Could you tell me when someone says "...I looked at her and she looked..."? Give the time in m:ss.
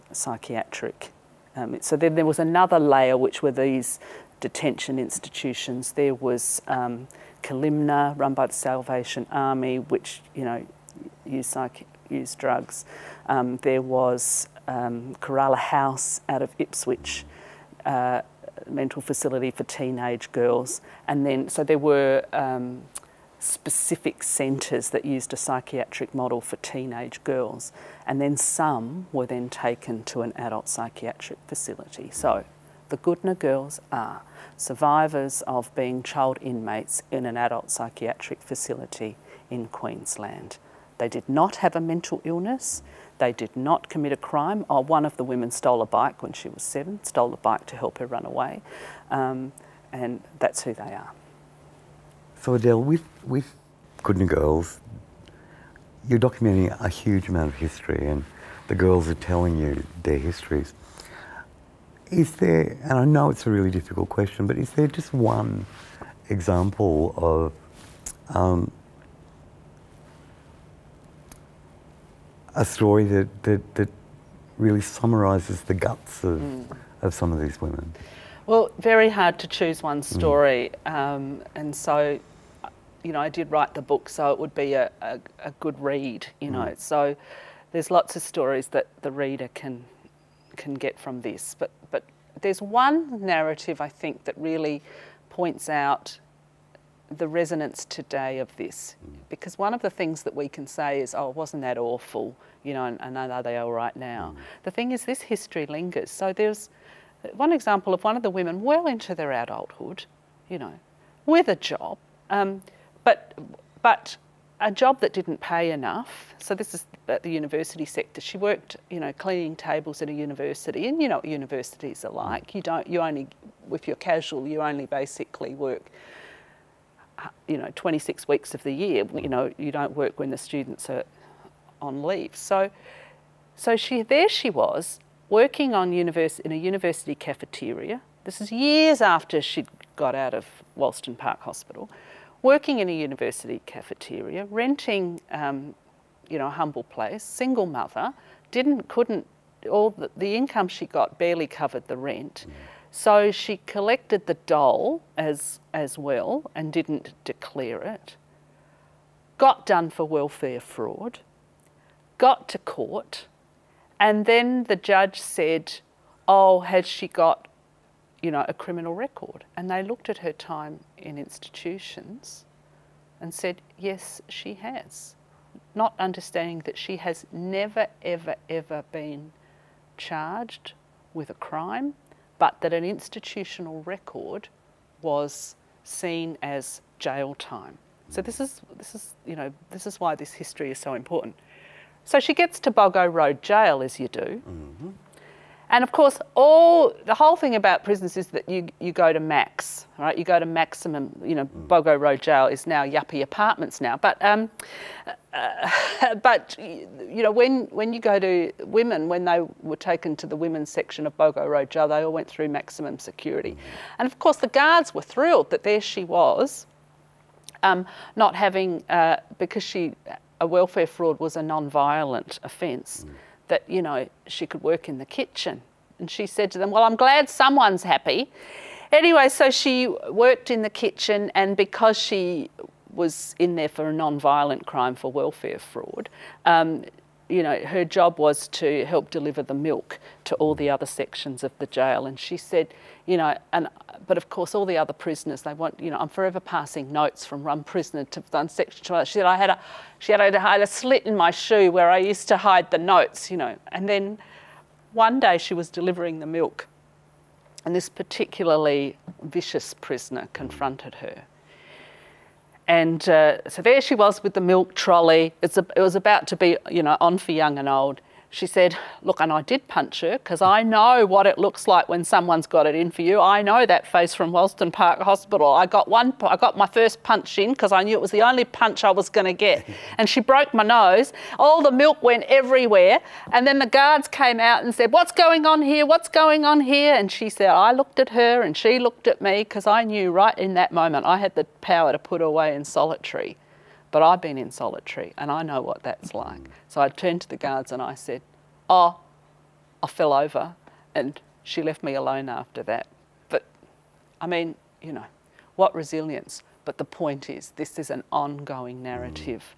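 4:47.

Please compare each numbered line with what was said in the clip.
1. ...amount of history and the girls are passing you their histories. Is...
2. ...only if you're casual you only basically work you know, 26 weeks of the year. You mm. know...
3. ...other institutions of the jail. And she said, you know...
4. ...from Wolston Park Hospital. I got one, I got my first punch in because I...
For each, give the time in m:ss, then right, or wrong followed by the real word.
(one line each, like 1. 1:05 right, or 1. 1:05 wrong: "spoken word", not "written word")
1. 0:57 wrong: "telling", not "passing"
2. 2:03 right
3. 4:00 wrong: "sections", not "institutions"
4. 4:34 right.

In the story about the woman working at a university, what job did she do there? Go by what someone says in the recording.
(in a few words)
Cleaning tables.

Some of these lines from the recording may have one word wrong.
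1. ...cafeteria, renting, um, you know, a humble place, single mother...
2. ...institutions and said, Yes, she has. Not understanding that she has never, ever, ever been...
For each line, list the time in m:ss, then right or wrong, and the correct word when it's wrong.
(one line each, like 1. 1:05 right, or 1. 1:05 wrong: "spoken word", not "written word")
1. 2:23 right
2. 2:51 right.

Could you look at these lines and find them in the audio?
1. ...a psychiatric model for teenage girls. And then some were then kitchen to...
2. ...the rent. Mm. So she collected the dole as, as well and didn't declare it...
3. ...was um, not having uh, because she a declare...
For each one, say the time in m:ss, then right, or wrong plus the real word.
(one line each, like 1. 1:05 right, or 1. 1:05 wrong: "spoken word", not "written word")
1. 0:25 wrong: "taken", not "kitchen"
2. 2:31 right
3. 3:36 wrong: "welfare", not "declare".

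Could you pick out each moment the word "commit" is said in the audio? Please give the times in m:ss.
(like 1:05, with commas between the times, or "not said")
0:43.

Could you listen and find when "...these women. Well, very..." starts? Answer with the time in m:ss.
1:17.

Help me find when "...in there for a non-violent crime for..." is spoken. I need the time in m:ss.
3:53.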